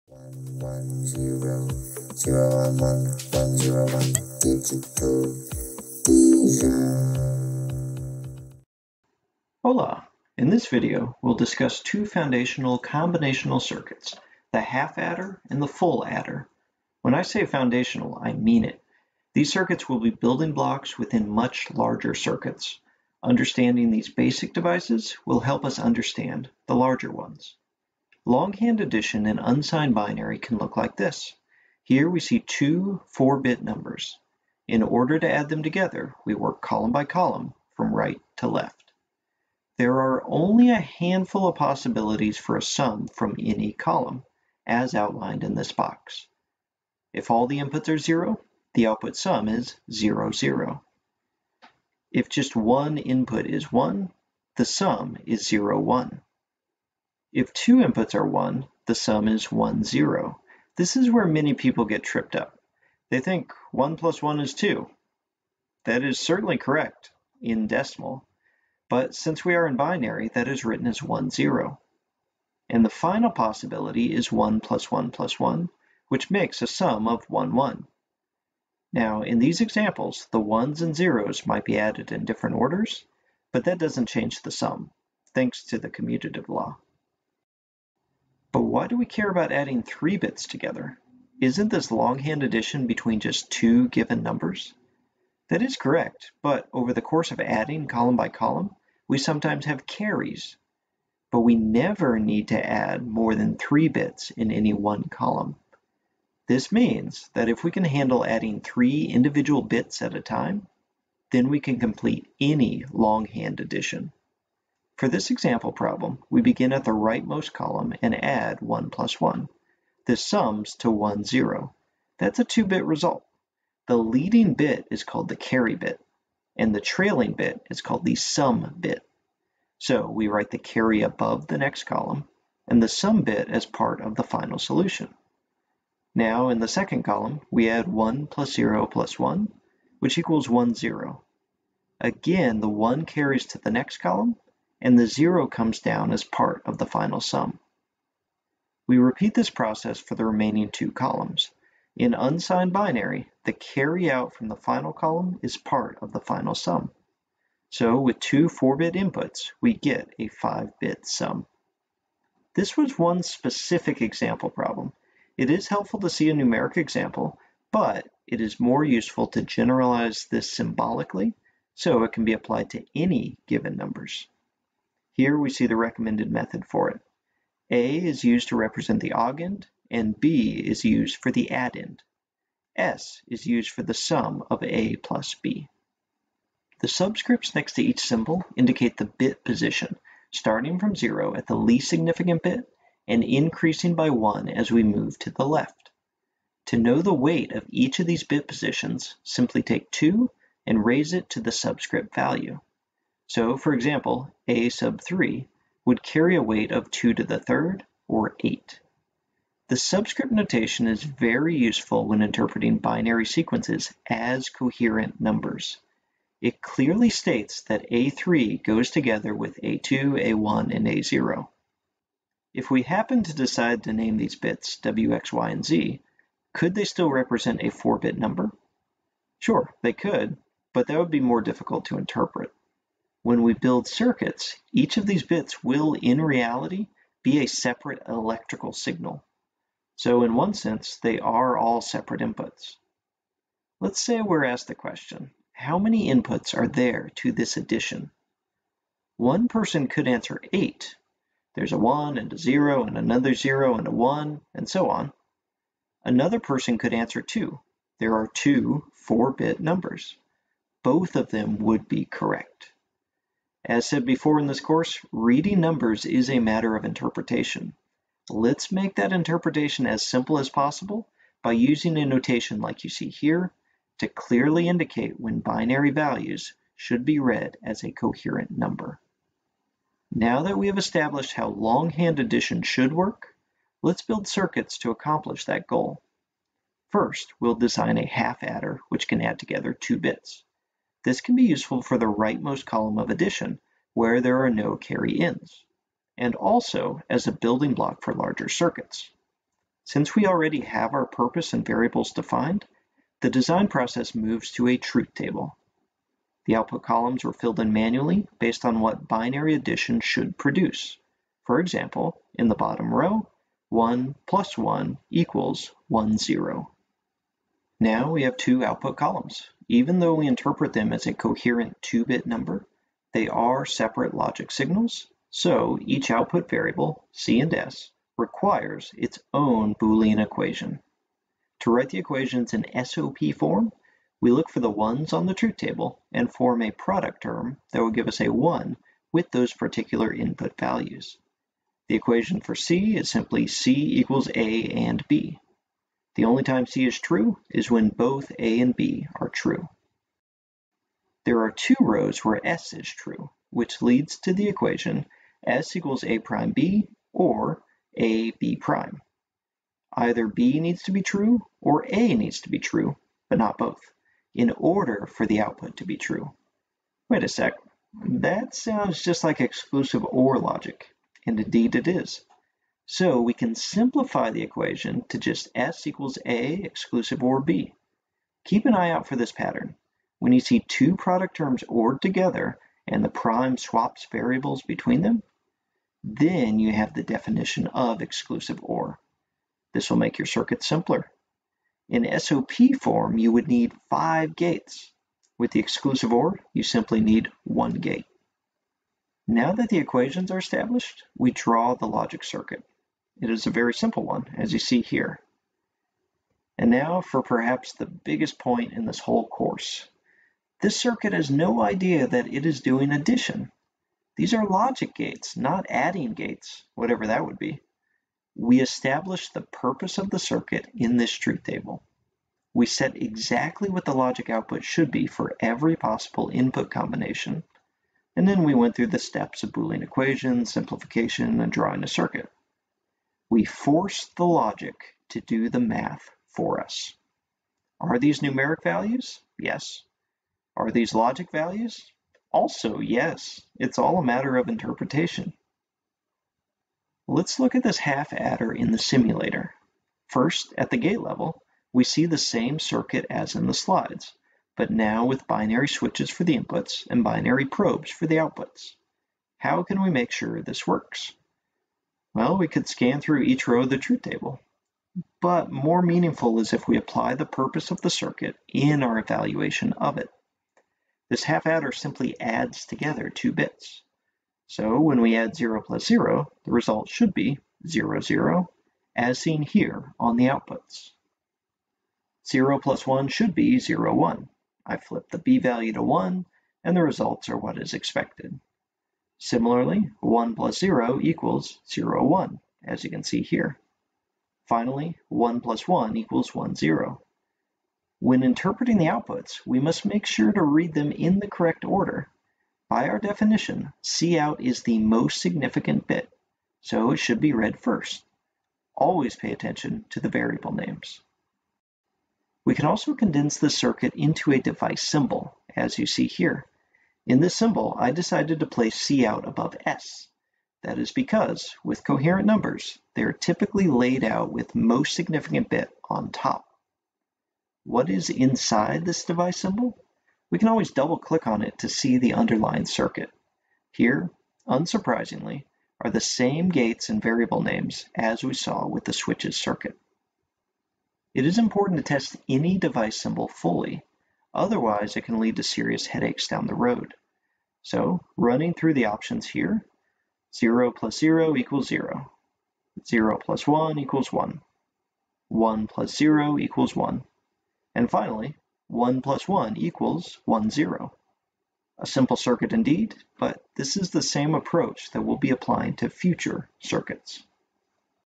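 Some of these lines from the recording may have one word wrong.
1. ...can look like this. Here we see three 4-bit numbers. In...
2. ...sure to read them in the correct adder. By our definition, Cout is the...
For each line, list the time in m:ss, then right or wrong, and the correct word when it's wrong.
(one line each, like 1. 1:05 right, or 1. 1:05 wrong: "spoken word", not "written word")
1. 0:30 wrong: "two", not "three"
2. 8:20 wrong: "order", not "adder".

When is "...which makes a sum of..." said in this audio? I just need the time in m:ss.
1:16.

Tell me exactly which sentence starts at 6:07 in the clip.
Wait a sec, that sounds just like exclusive OR logic, and indeed it is.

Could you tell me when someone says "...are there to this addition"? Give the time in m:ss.
4:06.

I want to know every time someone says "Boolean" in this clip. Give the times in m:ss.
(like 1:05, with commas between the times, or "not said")
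5:29, 7:09.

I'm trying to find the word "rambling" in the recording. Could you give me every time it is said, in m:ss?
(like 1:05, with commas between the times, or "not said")
not said.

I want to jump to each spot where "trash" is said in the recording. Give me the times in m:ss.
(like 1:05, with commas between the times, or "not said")
not said.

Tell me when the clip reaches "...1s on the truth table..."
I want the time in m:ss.
5:34.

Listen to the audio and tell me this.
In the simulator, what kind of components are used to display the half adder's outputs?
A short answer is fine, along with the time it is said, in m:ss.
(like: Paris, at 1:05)
binary probes, at 7:37.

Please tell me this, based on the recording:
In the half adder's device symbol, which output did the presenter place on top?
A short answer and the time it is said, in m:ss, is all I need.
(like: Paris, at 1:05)
C out, at 8:38.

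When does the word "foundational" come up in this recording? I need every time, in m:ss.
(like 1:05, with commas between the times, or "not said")
0:12, 0:17.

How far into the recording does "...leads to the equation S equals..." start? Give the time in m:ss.
5:53.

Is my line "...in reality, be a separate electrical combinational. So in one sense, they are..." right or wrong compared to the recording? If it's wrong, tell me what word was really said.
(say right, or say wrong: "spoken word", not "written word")
wrong: "signal", not "combinational".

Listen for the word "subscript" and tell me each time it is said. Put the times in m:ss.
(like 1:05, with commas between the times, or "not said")
3:06, 3:21, 3:29.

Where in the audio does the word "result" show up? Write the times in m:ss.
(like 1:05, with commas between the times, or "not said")
2:02, 7:56, 8:06.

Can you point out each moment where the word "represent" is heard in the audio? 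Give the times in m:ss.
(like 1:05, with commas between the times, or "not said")
2:58, 3:47.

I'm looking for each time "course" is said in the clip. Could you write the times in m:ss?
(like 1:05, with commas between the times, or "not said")
1:37, 4:24, 6:49.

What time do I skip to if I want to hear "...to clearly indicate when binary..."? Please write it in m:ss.
4:33.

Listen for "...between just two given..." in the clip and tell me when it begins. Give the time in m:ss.
1:32.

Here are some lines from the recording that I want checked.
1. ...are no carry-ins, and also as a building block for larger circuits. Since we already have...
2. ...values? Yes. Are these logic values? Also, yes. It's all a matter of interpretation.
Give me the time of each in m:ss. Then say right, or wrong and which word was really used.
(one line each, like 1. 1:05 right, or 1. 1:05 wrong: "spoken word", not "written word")
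1. 4:54 right
2. 7:18 right.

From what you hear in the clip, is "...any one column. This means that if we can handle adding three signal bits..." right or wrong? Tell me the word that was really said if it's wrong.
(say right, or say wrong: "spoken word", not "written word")
wrong: "individual", not "signal".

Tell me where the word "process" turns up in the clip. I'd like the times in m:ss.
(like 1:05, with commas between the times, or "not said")
2:29, 5:03.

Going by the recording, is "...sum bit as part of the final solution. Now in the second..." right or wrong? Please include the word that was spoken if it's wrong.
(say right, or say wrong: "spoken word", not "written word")
right.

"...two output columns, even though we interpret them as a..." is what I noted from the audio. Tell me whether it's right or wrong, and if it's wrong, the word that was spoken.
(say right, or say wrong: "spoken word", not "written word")
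right.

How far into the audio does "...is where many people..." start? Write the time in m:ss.
1:00.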